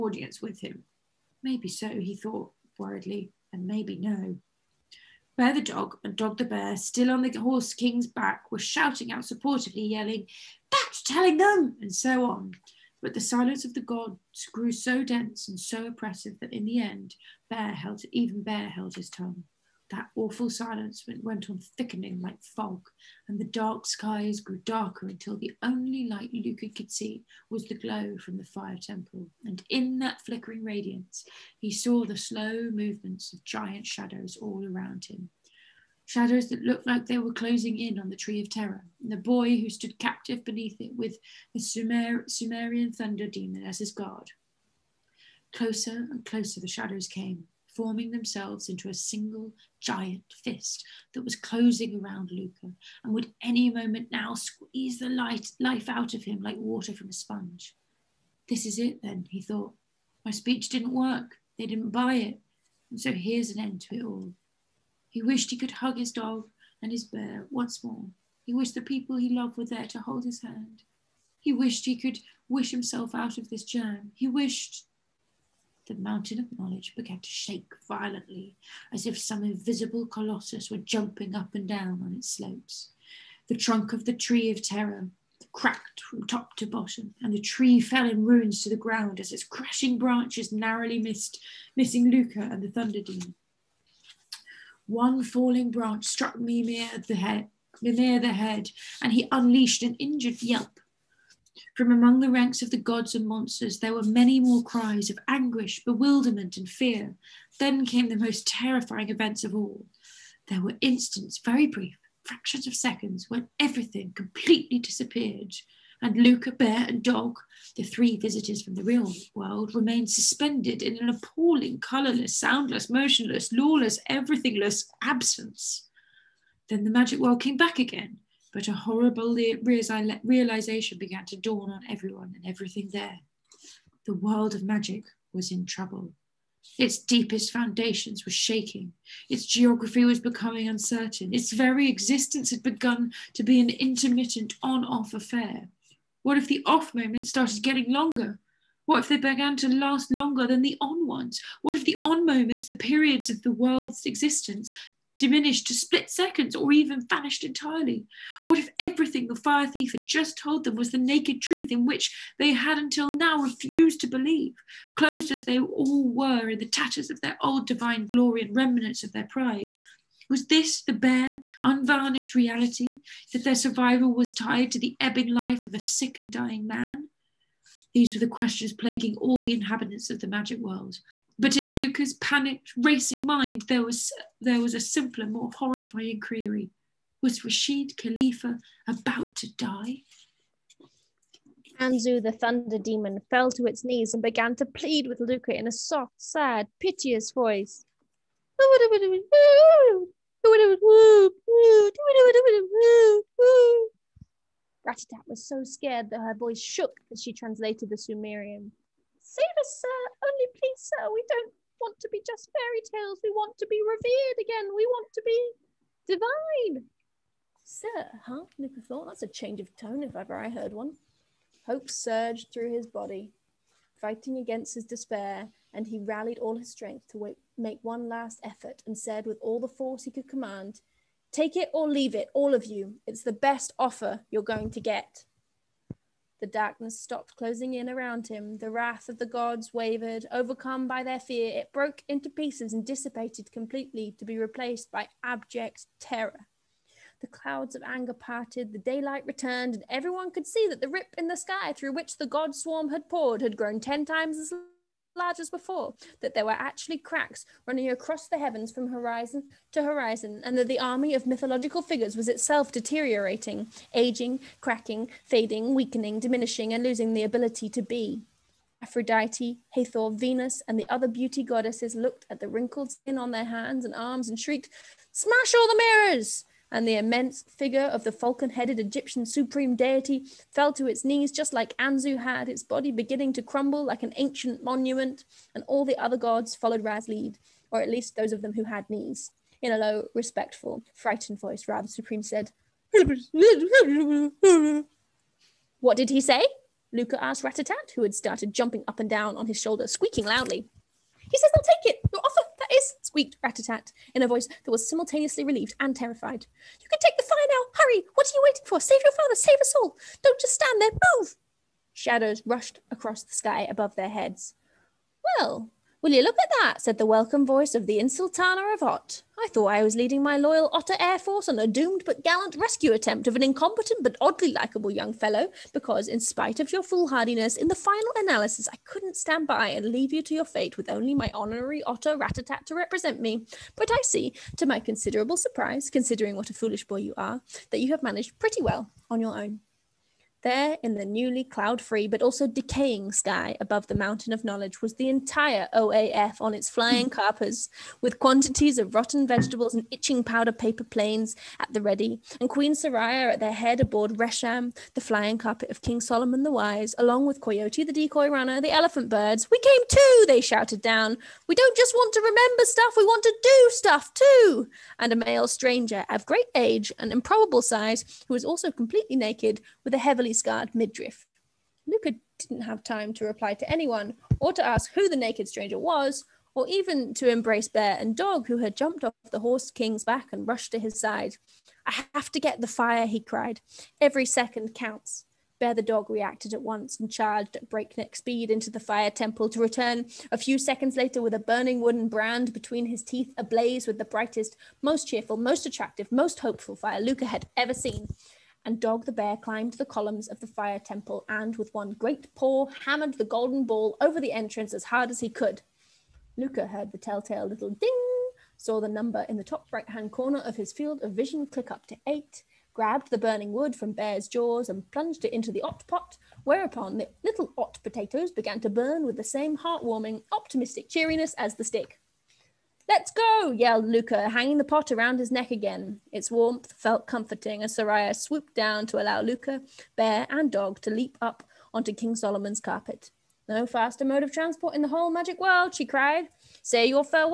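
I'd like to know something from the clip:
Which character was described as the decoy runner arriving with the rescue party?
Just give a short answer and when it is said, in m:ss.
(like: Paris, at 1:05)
Coyote, at 5:57.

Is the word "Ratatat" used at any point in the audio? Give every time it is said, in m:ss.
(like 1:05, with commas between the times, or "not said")
3:24, 4:57, 5:03, 5:32.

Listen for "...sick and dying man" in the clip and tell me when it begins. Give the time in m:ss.
2:55.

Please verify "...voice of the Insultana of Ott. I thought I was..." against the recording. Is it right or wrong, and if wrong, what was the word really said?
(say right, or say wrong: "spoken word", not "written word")
right.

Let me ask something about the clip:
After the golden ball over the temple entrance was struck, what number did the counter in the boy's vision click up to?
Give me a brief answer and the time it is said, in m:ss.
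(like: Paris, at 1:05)
8, at 6:52.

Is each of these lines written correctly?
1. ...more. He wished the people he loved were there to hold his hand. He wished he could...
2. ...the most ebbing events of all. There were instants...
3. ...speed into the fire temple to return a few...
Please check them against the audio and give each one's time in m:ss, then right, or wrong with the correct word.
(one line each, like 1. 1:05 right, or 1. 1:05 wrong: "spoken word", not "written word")
1. 1:07 right
2. 1:48 wrong: "terrifying", not "ebbing"
3. 6:28 right.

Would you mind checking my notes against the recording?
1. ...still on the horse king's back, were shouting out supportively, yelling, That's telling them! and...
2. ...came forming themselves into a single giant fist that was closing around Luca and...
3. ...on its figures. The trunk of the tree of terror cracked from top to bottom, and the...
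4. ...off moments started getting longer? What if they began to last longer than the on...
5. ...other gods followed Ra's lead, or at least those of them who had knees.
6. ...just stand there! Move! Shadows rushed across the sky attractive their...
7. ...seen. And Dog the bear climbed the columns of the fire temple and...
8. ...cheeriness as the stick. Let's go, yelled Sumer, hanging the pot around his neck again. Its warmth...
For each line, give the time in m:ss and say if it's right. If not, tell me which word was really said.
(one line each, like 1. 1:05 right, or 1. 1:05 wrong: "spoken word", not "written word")
1. 0:06 right
2. 0:47 right
3. 1:22 wrong: "slopes", not "figures"
4. 2:26 right
5. 4:45 right
6. 5:10 wrong: "above", not "attractive"
7. 6:37 right
8. 7:00 wrong: "Luka", not "Sumer".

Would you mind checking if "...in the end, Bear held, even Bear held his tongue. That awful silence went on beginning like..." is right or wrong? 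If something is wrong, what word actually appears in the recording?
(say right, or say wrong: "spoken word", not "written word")
wrong: "thickening", not "beginning".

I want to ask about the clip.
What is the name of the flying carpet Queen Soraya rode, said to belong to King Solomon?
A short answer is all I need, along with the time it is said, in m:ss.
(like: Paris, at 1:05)
Resham, at 5:54.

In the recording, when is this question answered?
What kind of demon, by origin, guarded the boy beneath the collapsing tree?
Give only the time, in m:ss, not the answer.
0:42.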